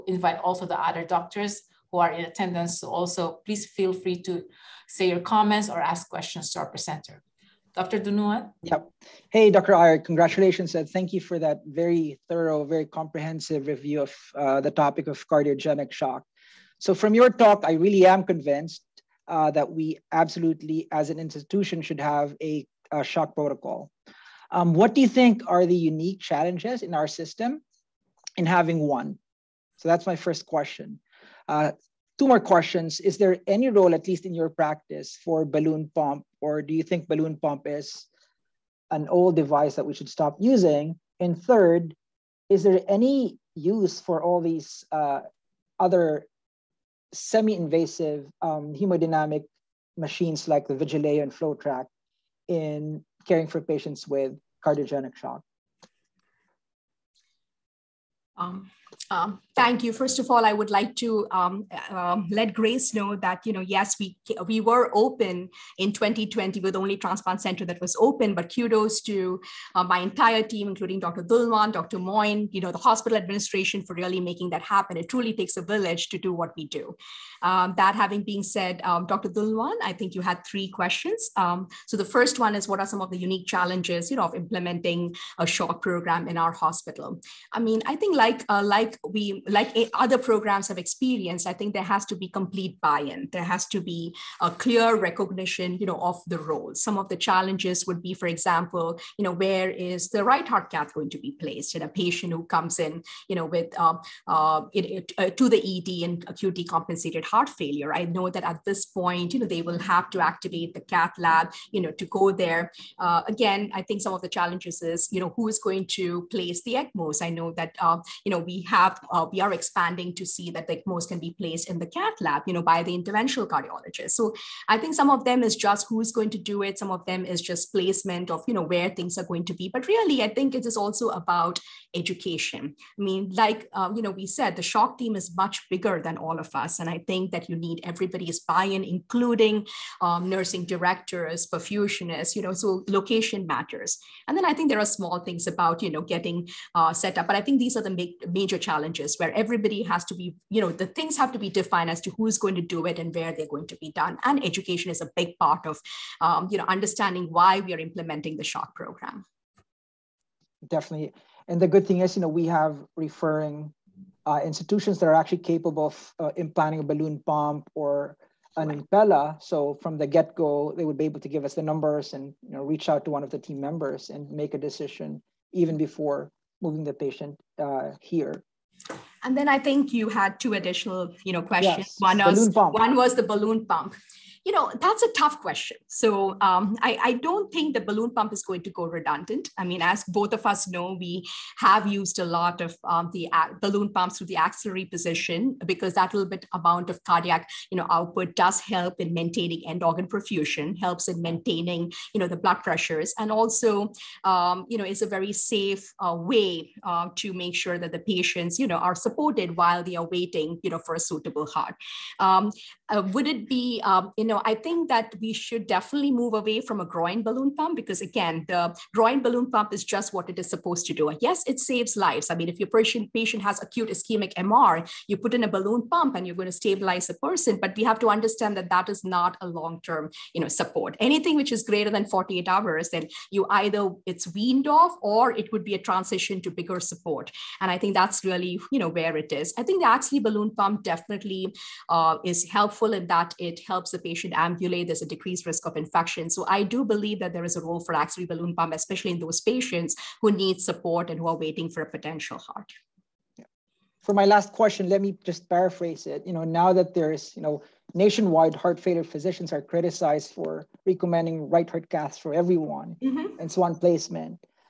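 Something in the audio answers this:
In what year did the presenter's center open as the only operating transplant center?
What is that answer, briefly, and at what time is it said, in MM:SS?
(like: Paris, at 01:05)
2020, at 01:05.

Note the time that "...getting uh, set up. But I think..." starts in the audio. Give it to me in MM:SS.
02:26.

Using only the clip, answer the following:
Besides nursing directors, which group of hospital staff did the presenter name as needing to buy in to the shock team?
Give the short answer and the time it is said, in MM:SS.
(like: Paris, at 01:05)
Perfusionists, at 02:21.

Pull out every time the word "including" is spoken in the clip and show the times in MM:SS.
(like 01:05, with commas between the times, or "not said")
01:10, 02:18.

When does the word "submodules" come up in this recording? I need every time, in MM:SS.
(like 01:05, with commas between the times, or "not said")
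not said.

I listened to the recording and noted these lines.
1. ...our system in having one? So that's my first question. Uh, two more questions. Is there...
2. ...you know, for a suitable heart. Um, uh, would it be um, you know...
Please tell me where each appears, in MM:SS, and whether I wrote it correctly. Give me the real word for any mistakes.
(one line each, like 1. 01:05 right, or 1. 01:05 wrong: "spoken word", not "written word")
1. 00:26 right
2. 03:30 right.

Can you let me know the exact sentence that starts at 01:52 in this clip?
Uh, again, I think some of the challenges is, you know, who is going to place the ECMOs.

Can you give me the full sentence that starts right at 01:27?
I mean, I think like uh, like we like eh, other programs have experienced, I think there has to be complete buy-in.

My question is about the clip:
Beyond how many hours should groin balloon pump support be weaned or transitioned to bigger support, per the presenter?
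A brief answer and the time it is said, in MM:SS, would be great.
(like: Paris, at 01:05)
48 hours, at 03:52.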